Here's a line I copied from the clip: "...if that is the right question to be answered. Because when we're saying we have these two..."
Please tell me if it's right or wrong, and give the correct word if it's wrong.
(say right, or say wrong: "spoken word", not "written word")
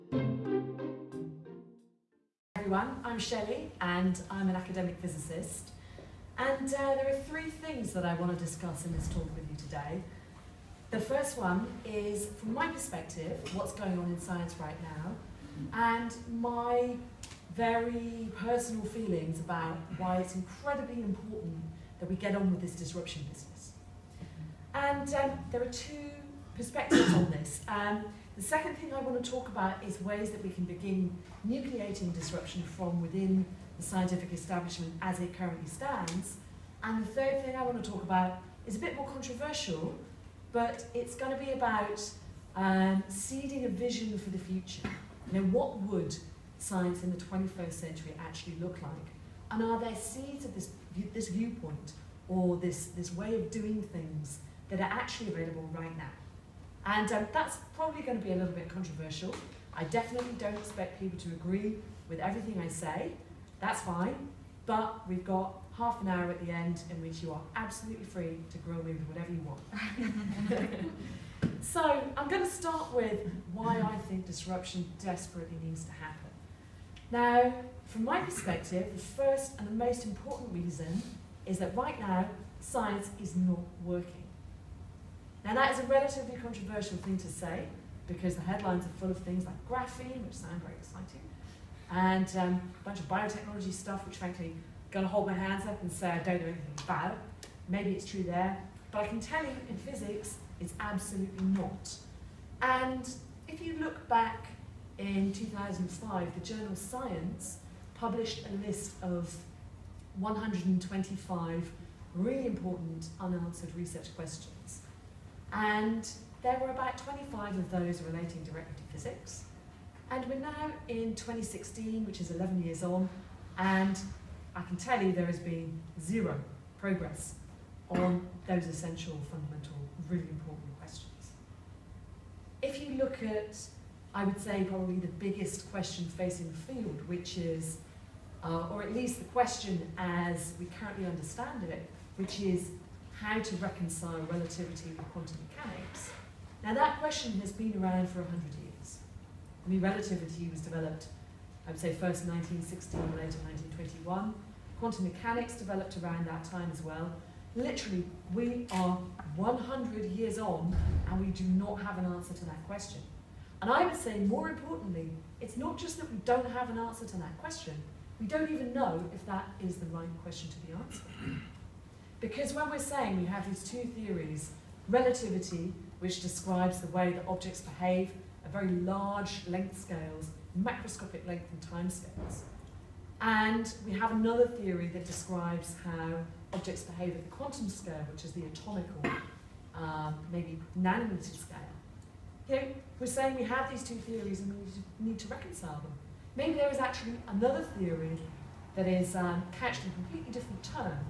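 right.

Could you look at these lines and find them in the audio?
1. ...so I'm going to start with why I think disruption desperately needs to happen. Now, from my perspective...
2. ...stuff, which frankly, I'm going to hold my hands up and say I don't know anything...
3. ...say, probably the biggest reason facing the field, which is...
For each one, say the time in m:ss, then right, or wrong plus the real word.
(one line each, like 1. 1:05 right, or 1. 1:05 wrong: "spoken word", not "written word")
1. 1:11 right
2. 1:33 right
3. 2:14 wrong: "question", not "reason".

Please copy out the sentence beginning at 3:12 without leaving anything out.
You know, we're saying we have these two theories and we need to reconcile them.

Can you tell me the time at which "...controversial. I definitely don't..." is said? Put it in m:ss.
0:58.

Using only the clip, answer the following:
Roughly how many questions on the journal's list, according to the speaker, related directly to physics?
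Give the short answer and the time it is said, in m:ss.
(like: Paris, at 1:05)
25, at 1:56.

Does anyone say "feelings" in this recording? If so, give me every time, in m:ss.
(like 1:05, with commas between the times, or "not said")
0:18.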